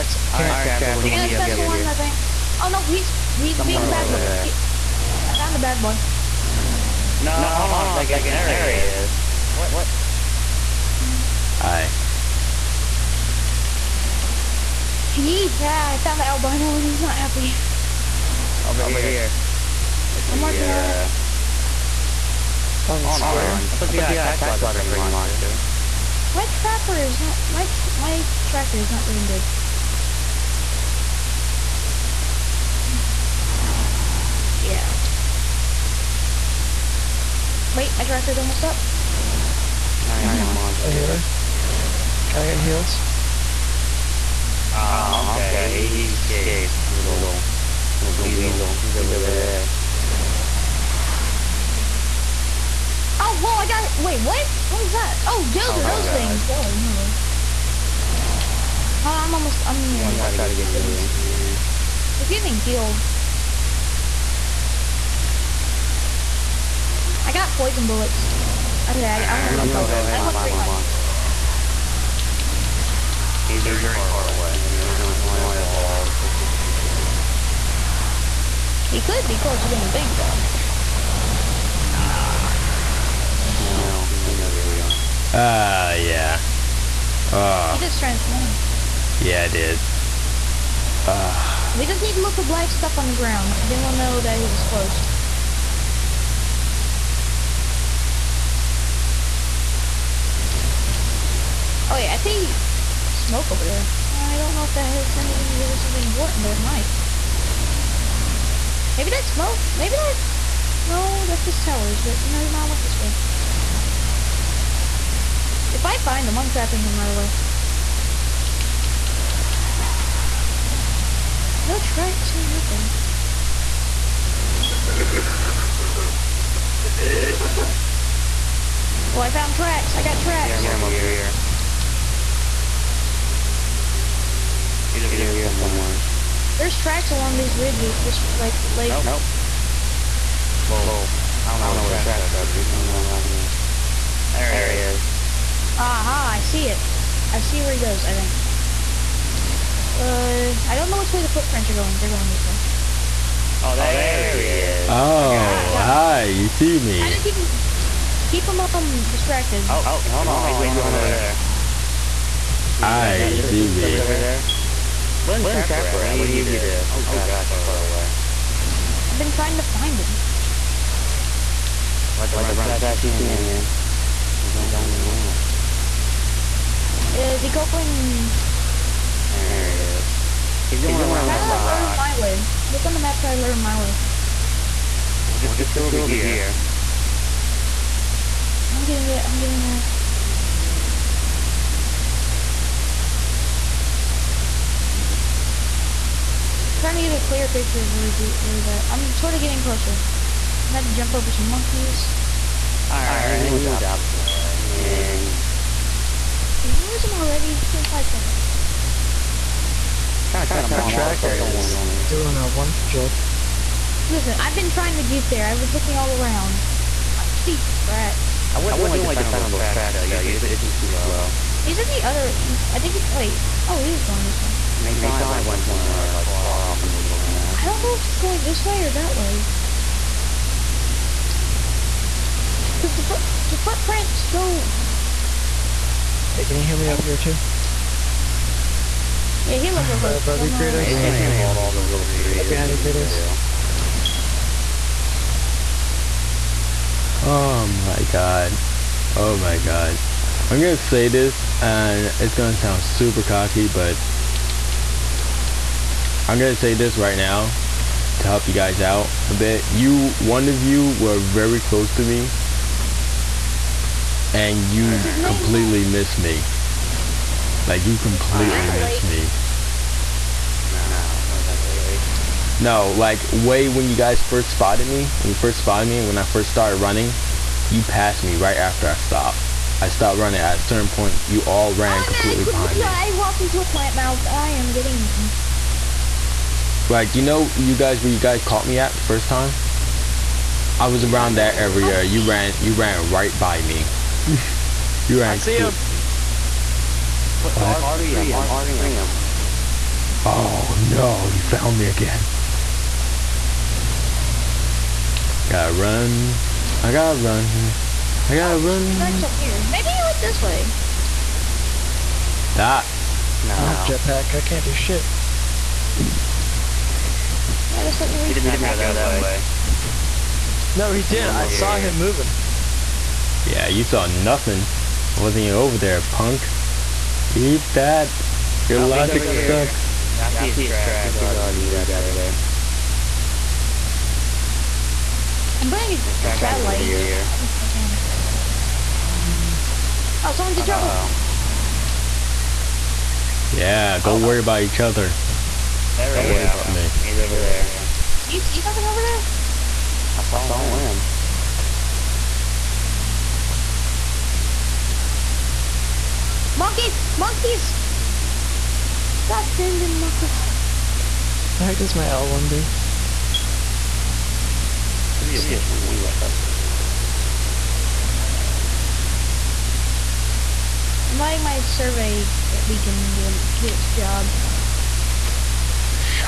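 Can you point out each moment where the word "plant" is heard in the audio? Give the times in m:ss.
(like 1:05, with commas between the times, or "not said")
4:43.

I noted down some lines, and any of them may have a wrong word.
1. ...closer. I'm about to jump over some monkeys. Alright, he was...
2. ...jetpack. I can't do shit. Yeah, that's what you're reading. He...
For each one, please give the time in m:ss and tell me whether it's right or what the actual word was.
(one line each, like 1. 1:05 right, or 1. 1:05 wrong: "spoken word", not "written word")
1. 3:19 right
2. 5:13 right.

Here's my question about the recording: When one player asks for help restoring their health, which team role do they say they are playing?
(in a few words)
Healer.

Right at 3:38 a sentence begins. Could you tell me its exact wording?
I wouldn't, I wouldn't really depend, on those tracks, though.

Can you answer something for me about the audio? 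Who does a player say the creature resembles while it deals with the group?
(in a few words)
Bobby Kratos.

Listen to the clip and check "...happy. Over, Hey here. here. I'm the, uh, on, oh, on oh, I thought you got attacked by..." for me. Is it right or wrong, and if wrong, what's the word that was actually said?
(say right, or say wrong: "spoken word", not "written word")
wrong: "Over", not "Hey".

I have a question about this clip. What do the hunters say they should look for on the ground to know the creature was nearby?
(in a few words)
Black stuff.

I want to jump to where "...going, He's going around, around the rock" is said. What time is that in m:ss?
3:00.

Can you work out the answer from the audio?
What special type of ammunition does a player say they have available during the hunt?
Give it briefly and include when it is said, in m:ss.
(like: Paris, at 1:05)
Poison bullets, at 1:07.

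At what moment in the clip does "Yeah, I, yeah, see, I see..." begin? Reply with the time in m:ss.
5:30.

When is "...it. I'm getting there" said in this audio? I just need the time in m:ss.
3:09.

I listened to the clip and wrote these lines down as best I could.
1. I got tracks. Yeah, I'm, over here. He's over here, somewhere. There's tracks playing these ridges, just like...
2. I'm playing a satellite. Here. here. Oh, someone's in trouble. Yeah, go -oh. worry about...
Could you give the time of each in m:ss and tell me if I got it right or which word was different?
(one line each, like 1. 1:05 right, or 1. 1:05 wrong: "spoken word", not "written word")
1. 2:09 wrong: "along", not "playing"
2. 5:35 right.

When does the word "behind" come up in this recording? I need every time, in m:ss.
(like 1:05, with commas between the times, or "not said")
4:02, 4:42.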